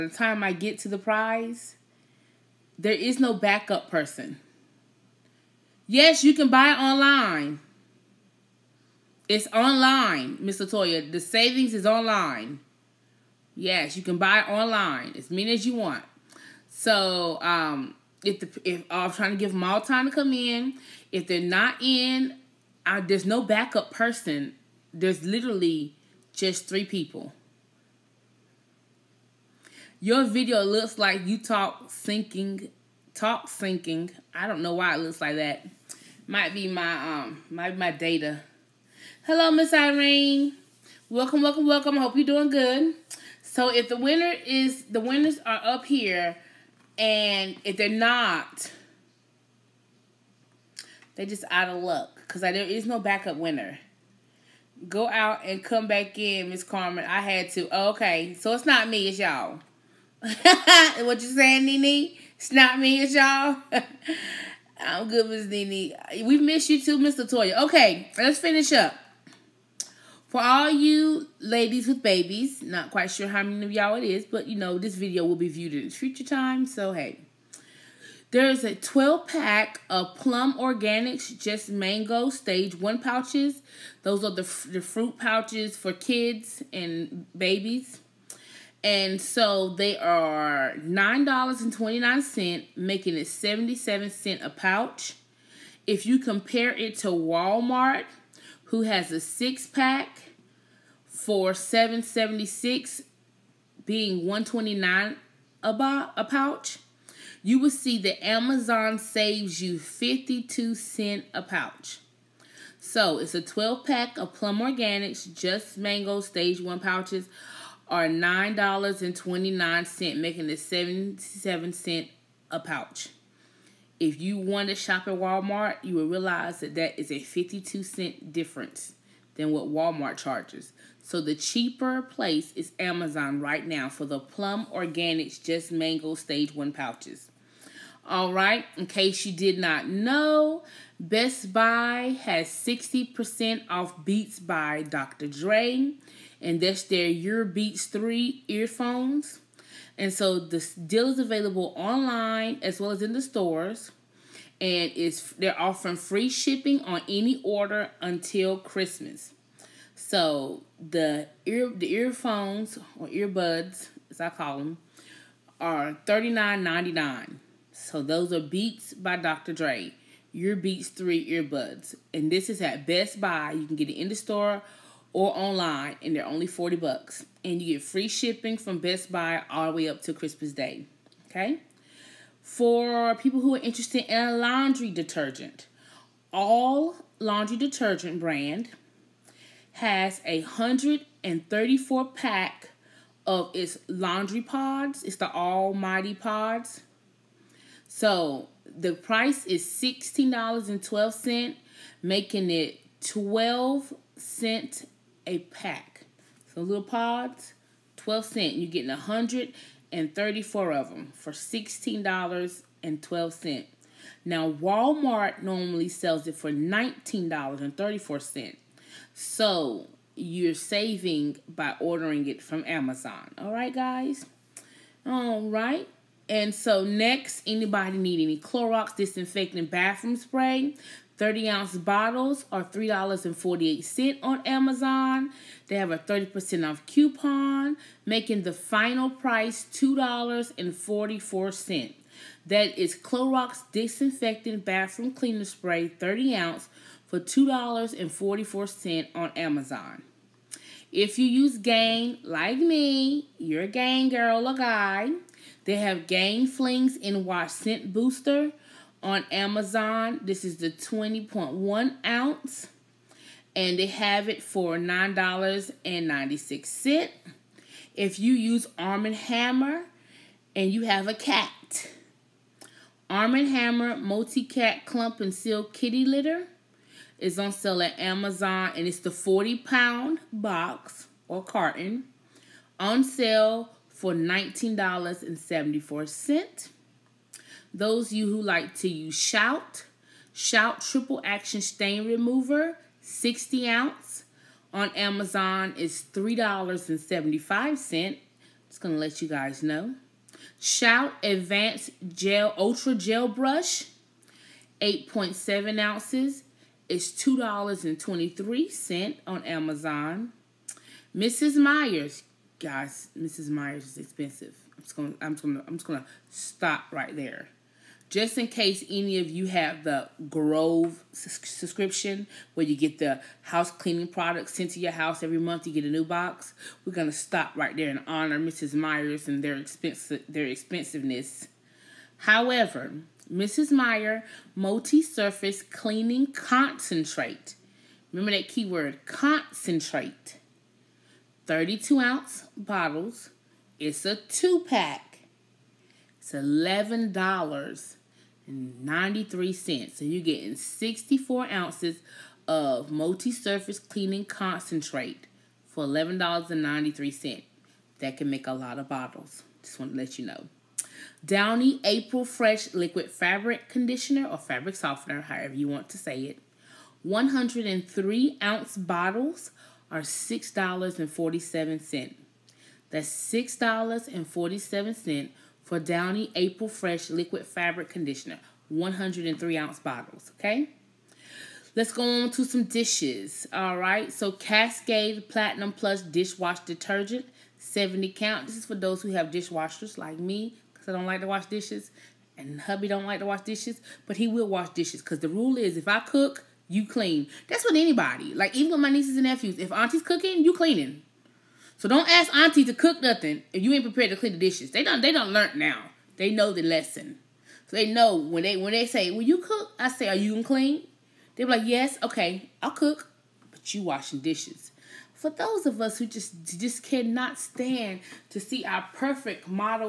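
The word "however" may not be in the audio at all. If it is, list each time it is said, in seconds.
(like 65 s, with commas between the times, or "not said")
332 s, 365 s.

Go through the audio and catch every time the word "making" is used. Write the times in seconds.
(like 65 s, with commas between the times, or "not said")
92 s, 120 s, 202 s, 238 s.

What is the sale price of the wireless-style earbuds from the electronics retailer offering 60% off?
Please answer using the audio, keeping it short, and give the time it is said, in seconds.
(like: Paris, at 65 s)
$39.99, at 166 s.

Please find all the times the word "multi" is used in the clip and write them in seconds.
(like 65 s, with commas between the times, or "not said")
273 s, 334 s, 352 s.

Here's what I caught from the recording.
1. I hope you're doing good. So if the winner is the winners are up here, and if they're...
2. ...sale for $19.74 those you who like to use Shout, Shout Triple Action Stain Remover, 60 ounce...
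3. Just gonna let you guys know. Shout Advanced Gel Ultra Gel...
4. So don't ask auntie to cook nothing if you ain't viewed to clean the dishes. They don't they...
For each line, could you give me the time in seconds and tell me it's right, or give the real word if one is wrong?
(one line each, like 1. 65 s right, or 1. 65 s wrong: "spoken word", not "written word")
1. 41 s right
2. 283 s right
3. 298 s right
4. 401 s wrong: "prepared", not "viewed".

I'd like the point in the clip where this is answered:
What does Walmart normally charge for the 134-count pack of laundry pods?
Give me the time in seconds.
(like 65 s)
216 s.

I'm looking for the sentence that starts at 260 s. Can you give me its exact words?
This is the 20.1 ounce, and they have it for $9.96.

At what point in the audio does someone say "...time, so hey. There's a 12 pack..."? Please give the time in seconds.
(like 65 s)
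76 s.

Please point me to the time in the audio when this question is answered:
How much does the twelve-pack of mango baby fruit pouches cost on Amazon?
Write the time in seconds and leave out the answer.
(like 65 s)
89 s.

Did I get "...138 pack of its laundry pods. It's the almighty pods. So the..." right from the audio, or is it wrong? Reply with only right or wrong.
wrong.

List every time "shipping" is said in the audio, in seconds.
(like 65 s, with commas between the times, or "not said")
156 s, 178 s.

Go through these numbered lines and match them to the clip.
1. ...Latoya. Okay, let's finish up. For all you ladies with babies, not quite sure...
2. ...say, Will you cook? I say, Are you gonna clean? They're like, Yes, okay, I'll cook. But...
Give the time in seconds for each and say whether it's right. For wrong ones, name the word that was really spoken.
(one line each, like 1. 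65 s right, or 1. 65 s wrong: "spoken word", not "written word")
1. 67 s right
2. 408 s right.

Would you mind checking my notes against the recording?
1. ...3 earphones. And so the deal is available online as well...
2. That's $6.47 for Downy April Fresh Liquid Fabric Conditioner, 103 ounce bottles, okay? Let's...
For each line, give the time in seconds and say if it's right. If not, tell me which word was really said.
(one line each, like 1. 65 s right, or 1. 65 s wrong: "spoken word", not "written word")
1. 147 s right
2. 372 s right.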